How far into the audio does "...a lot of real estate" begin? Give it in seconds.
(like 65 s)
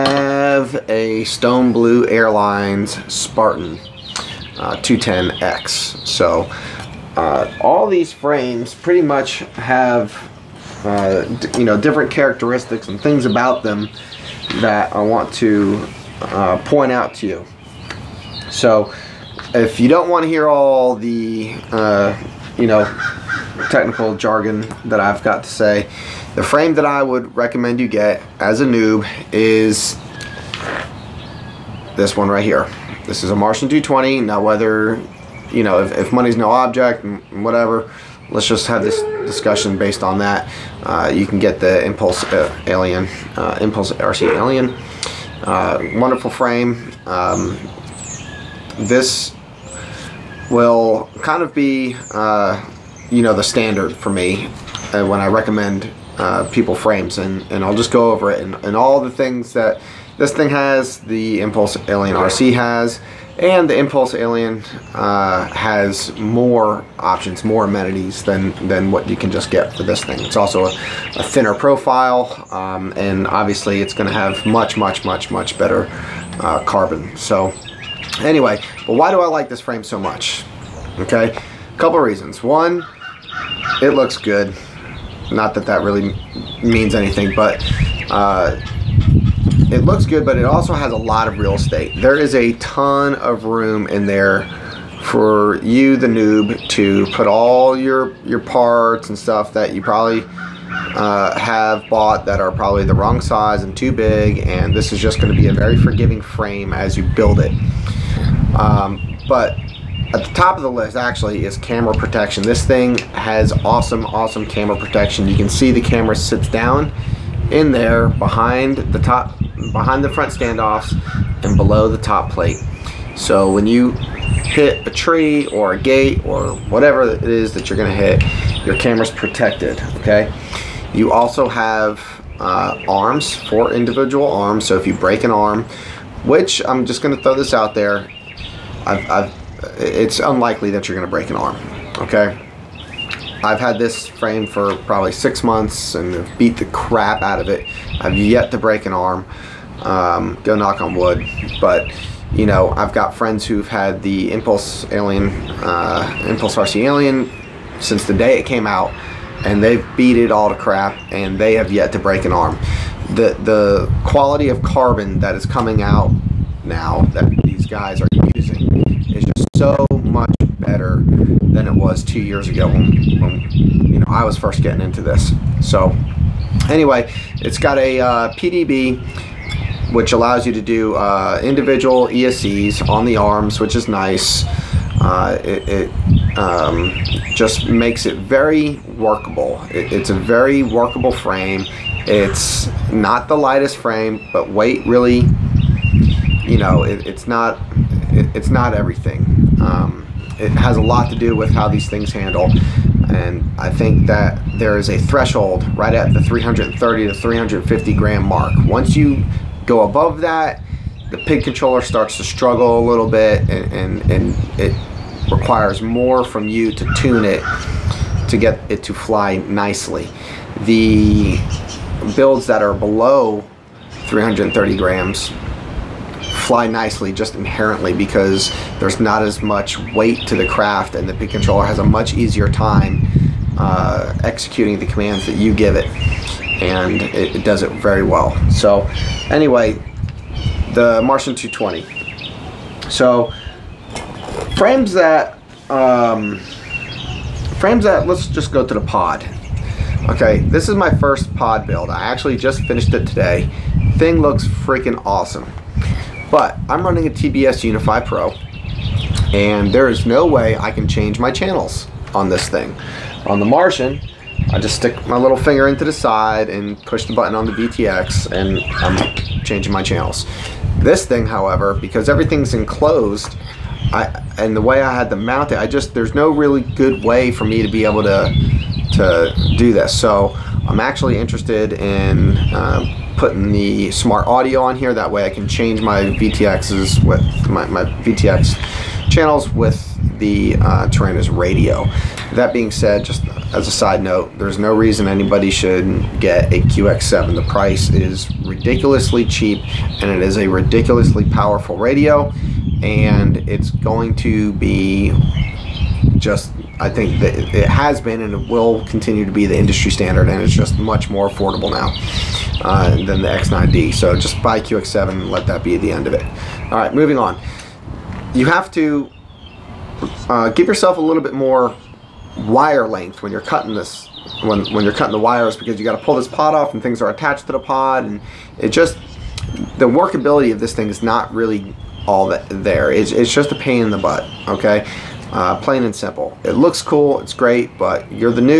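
90 s.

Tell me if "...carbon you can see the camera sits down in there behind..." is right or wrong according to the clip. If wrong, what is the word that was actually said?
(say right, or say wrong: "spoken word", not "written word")
wrong: "protection", not "carbon".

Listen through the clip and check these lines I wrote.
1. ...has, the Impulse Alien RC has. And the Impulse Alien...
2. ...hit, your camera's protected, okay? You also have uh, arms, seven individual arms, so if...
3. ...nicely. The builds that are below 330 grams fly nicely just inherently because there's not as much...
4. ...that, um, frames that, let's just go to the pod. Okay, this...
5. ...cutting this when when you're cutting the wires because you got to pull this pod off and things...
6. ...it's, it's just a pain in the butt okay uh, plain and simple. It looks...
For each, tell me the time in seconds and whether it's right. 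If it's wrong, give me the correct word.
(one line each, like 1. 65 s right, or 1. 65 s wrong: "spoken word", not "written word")
1. 60 s right
2. 127 s wrong: "four", not "seven"
3. 219 s right
4. 244 s right
5. 323 s right
6. 332 s right.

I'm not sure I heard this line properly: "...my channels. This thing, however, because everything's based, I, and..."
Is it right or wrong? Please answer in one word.
wrong.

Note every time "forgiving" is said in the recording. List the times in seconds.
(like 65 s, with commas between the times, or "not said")
105 s.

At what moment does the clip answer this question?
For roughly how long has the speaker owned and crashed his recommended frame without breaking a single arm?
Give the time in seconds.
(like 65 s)
145 s.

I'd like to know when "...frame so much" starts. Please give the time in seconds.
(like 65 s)
79 s.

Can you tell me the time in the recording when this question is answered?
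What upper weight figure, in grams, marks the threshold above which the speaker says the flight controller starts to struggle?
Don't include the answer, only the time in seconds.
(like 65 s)
207 s.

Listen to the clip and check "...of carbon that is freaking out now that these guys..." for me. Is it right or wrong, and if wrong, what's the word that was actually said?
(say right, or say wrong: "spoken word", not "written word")
wrong: "coming", not "freaking".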